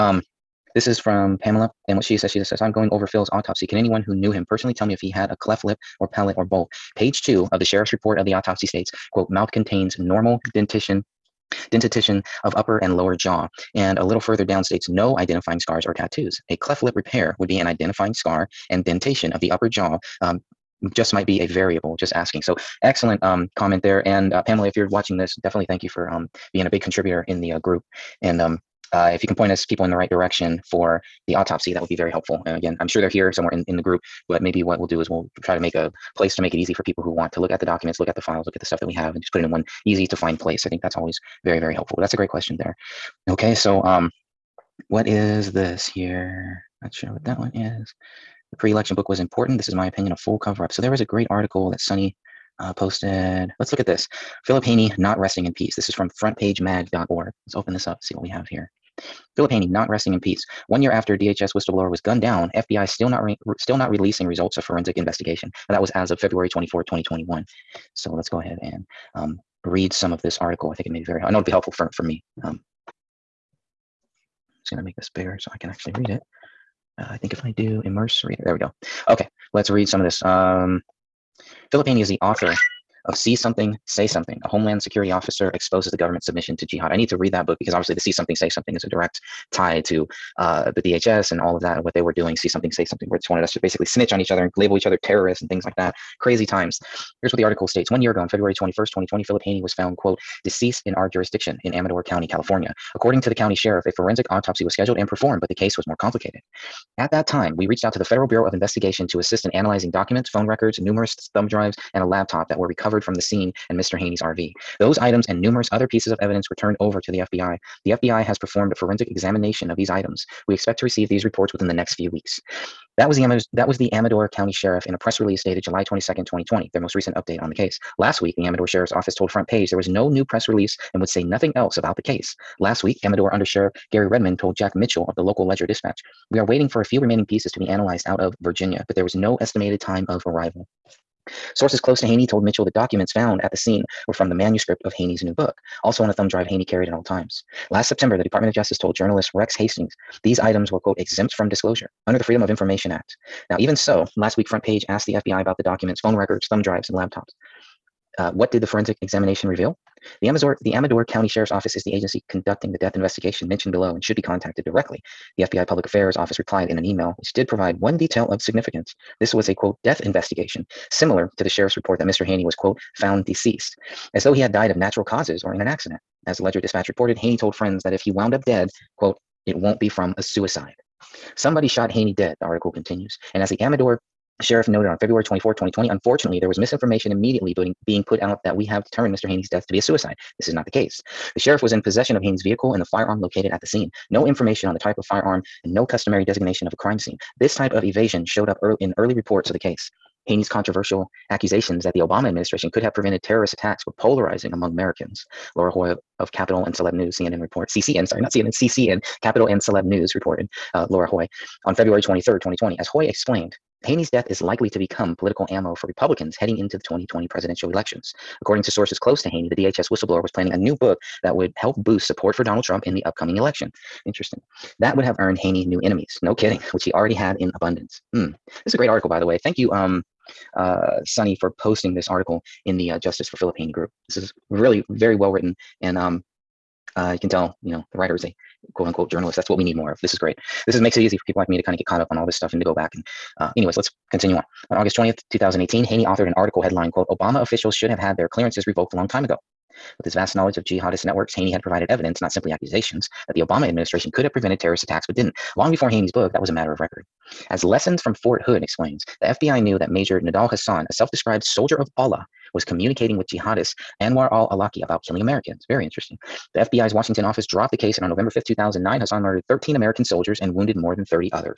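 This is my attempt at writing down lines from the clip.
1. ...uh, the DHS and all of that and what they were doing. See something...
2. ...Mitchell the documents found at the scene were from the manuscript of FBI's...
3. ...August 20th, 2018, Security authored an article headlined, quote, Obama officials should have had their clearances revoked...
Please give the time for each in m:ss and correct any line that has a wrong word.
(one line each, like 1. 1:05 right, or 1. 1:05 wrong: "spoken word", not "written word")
1. 1:30 right
2. 2:22 wrong: "Haney", not "FBI"
3. 4:04 wrong: "Haney", not "Security".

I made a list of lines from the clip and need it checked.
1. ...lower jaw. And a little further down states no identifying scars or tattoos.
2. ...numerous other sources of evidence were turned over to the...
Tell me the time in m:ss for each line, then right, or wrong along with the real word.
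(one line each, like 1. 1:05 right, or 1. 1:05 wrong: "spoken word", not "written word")
1. 0:12 right
2. 1:55 wrong: "pieces", not "sources".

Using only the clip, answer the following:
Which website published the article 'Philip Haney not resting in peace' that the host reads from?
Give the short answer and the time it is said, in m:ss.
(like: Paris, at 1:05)
frontpagemag.org, at 0:56.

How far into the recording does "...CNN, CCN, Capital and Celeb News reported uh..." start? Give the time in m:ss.
3:28.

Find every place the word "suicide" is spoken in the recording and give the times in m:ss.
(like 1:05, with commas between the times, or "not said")
3:00, 3:09.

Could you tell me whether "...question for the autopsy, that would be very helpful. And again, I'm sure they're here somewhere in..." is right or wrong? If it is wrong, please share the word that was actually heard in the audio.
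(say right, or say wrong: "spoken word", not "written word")
wrong: "direction", not "question".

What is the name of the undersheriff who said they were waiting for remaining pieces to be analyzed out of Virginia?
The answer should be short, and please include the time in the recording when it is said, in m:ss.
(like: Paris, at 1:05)
Gary Redmond, at 2:13.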